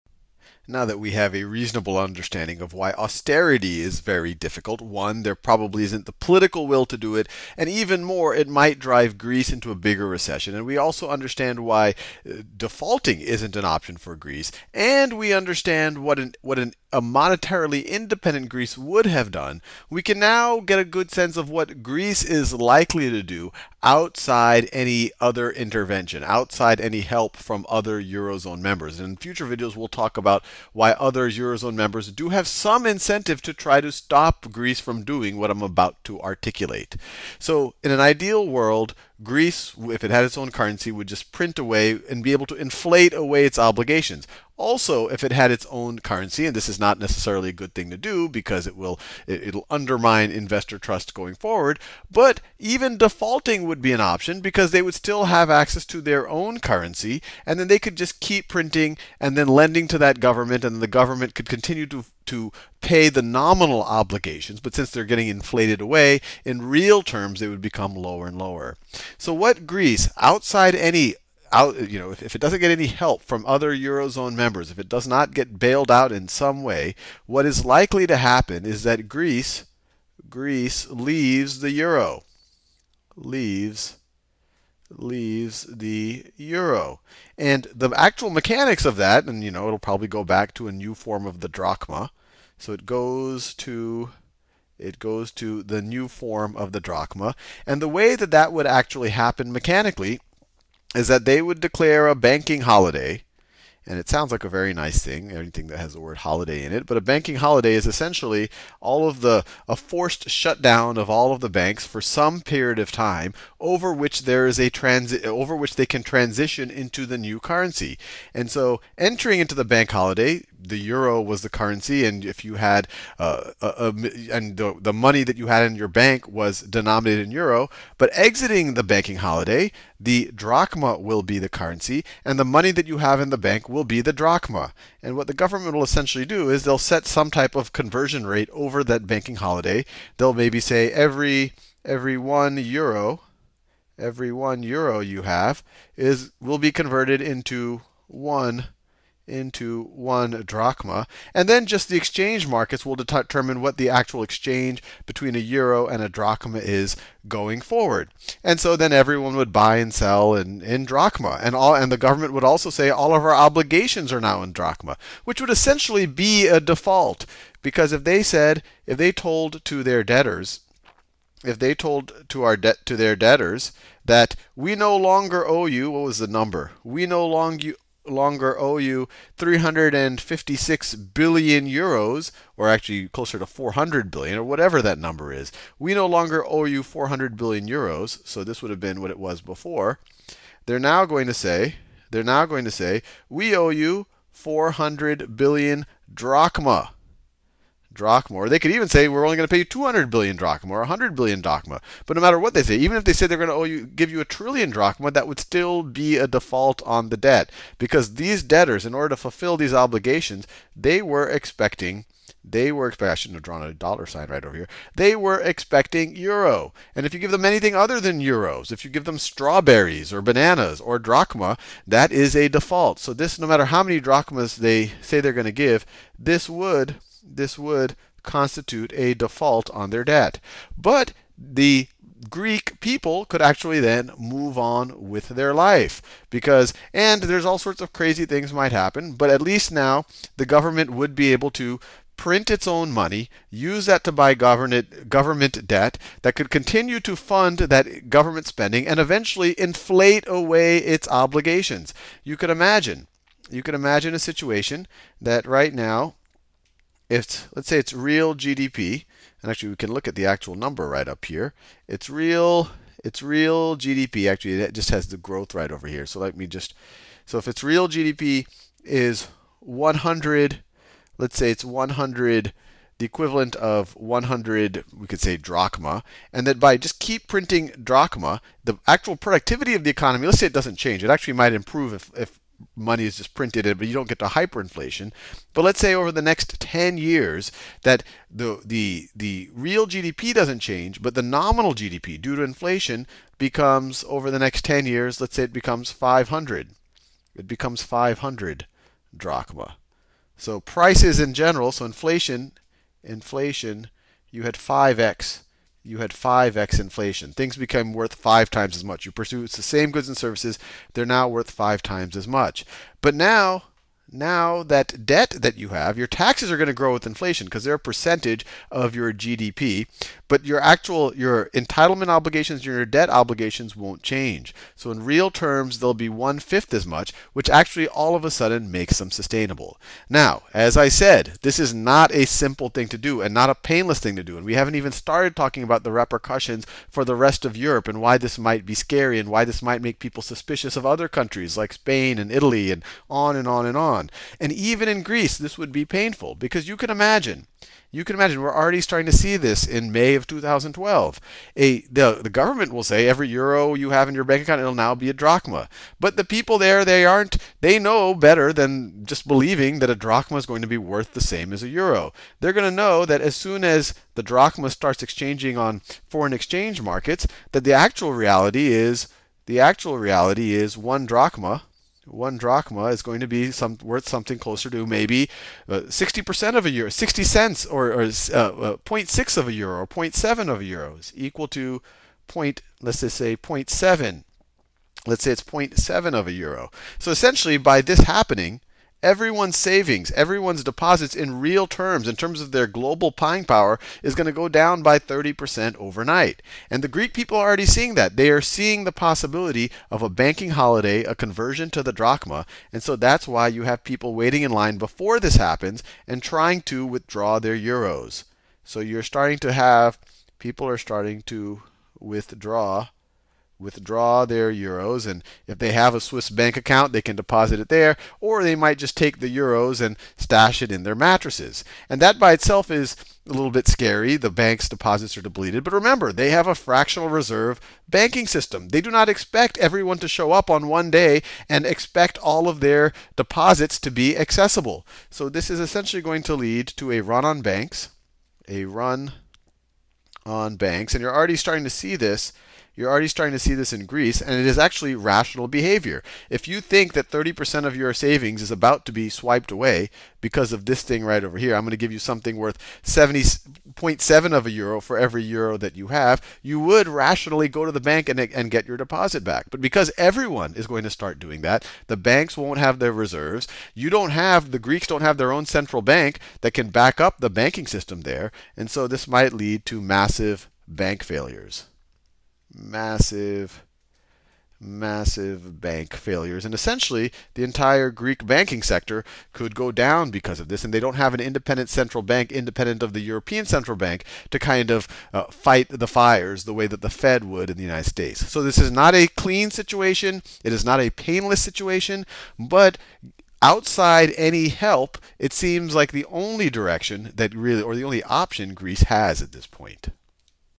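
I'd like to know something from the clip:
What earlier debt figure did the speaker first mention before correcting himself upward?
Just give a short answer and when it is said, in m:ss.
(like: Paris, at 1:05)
356 billion euros, at 2:59.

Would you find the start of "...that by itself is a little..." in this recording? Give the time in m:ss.
7:02.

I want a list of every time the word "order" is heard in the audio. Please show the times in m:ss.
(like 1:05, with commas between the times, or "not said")
3:28.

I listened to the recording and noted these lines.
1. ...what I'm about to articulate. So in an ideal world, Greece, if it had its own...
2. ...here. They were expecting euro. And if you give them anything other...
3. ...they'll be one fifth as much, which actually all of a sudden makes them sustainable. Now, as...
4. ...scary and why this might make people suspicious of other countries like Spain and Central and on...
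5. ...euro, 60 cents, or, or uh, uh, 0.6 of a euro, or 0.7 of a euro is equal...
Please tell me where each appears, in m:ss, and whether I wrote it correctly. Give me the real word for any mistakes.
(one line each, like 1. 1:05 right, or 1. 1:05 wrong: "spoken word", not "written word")
1. 0:35 right
2. 3:34 right
3. 5:25 right
4. 5:38 wrong: "Italy", not "Central"
5. 6:16 right.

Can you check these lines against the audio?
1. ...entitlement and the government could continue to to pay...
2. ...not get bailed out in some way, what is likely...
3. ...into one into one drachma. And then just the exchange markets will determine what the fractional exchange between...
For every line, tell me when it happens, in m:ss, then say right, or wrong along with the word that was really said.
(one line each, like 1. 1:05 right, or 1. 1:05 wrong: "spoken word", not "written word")
1. 1:00 wrong: "government", not "entitlement"
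2. 1:15 right
3. 2:27 wrong: "actual", not "fractional".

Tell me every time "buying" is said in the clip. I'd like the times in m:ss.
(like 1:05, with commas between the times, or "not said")
6:33.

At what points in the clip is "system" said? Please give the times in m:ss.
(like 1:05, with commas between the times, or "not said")
7:08, 7:47.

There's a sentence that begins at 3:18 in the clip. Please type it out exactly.
Or they could even say we're only going to pay you 200 billion drachma or 100 billion drachma.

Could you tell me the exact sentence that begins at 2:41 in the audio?
And, all, and the government would also say all of our obligations are now in drachma, which would essentially be a default.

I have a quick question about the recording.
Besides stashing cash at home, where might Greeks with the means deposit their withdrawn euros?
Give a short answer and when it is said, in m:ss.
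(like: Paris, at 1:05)
Swiss bank account, at 6:56.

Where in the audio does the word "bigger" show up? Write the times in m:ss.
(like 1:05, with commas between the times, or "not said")
0:09.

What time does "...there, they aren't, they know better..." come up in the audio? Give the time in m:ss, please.
5:56.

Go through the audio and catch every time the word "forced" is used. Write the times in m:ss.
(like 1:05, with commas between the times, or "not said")
1:49.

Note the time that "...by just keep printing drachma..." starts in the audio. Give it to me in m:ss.
4:36.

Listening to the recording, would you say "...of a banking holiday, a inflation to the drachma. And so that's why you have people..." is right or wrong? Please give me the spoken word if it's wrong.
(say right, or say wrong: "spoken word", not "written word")
wrong: "conversion", not "inflation".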